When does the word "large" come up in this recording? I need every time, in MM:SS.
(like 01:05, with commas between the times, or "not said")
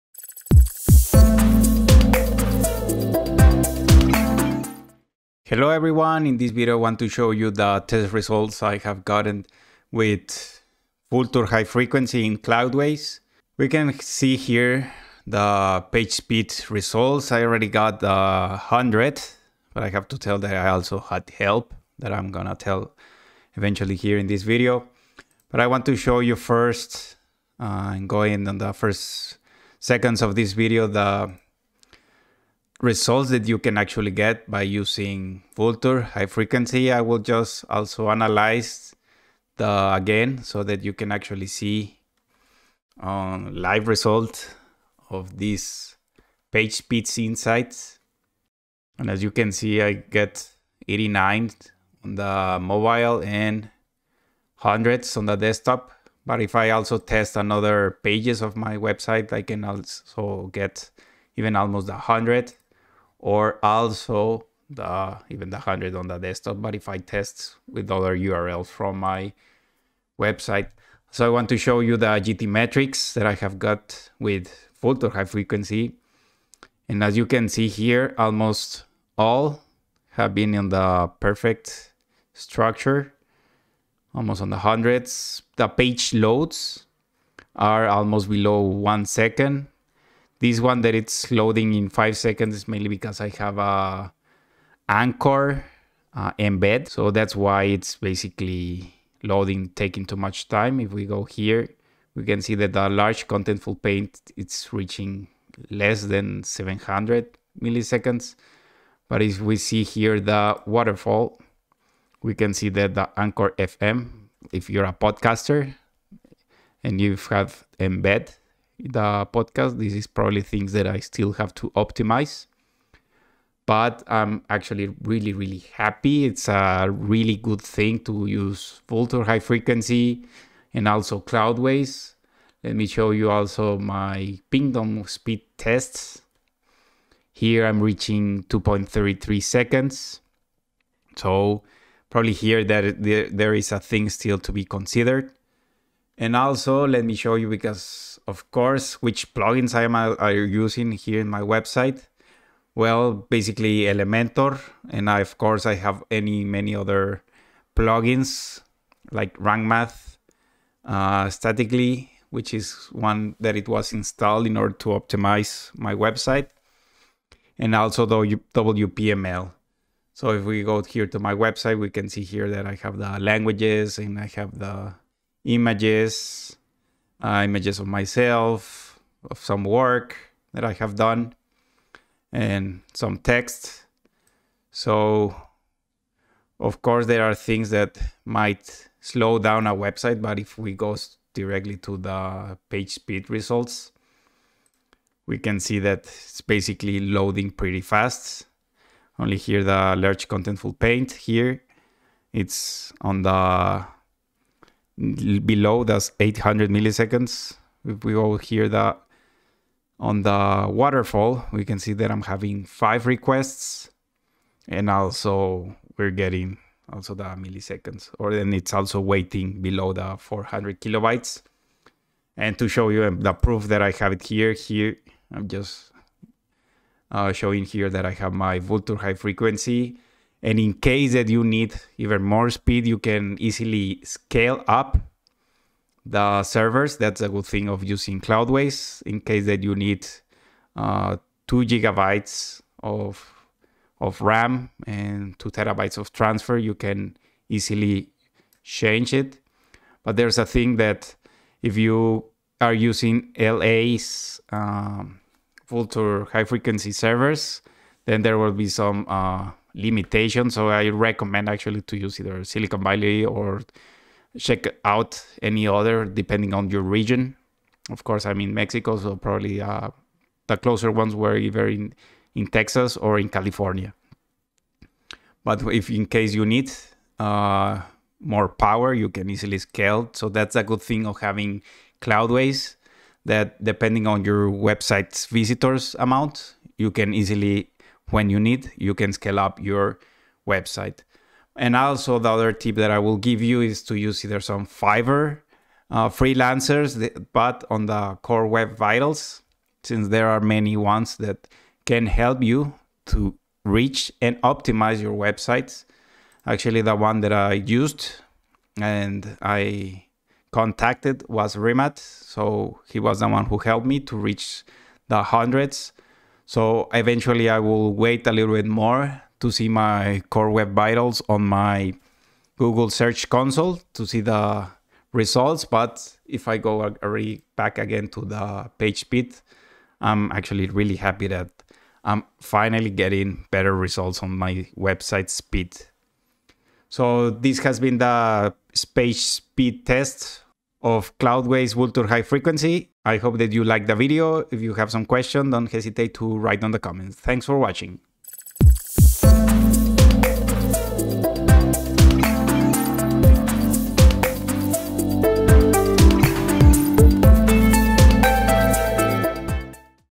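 01:42, 03:19.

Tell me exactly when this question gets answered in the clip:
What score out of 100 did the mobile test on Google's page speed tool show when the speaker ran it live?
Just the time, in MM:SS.
00:50.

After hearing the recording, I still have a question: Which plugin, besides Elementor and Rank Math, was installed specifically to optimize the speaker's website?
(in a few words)
Statically.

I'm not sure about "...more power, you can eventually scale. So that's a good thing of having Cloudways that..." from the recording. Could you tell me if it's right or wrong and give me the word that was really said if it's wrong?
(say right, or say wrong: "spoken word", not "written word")
wrong: "easily", not "eventually".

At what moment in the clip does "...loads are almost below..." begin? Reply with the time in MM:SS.
01:26.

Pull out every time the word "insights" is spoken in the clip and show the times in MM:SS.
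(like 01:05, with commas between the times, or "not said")
00:47.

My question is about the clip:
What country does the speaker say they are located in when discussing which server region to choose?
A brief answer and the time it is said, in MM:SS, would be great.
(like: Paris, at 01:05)
Mexico, at 04:28.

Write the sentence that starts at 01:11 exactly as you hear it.
So I want to show you the GTmetrix that I have got with Vultr High Frequency.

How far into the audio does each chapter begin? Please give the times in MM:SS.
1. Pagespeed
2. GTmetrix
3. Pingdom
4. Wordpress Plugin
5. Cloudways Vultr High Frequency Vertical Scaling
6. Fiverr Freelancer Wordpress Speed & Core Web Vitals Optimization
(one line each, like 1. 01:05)
1. 00:17
2. 01:10
3. 02:14
4. 02:28
5. 03:46
6. 04:50.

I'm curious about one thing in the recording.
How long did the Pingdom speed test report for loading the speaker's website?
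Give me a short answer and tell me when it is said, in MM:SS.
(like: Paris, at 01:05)
2.33 seconds, at 02:18.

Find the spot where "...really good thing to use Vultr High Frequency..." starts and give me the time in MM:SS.
02:06.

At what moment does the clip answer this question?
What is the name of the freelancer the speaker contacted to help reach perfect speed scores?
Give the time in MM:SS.
05:11.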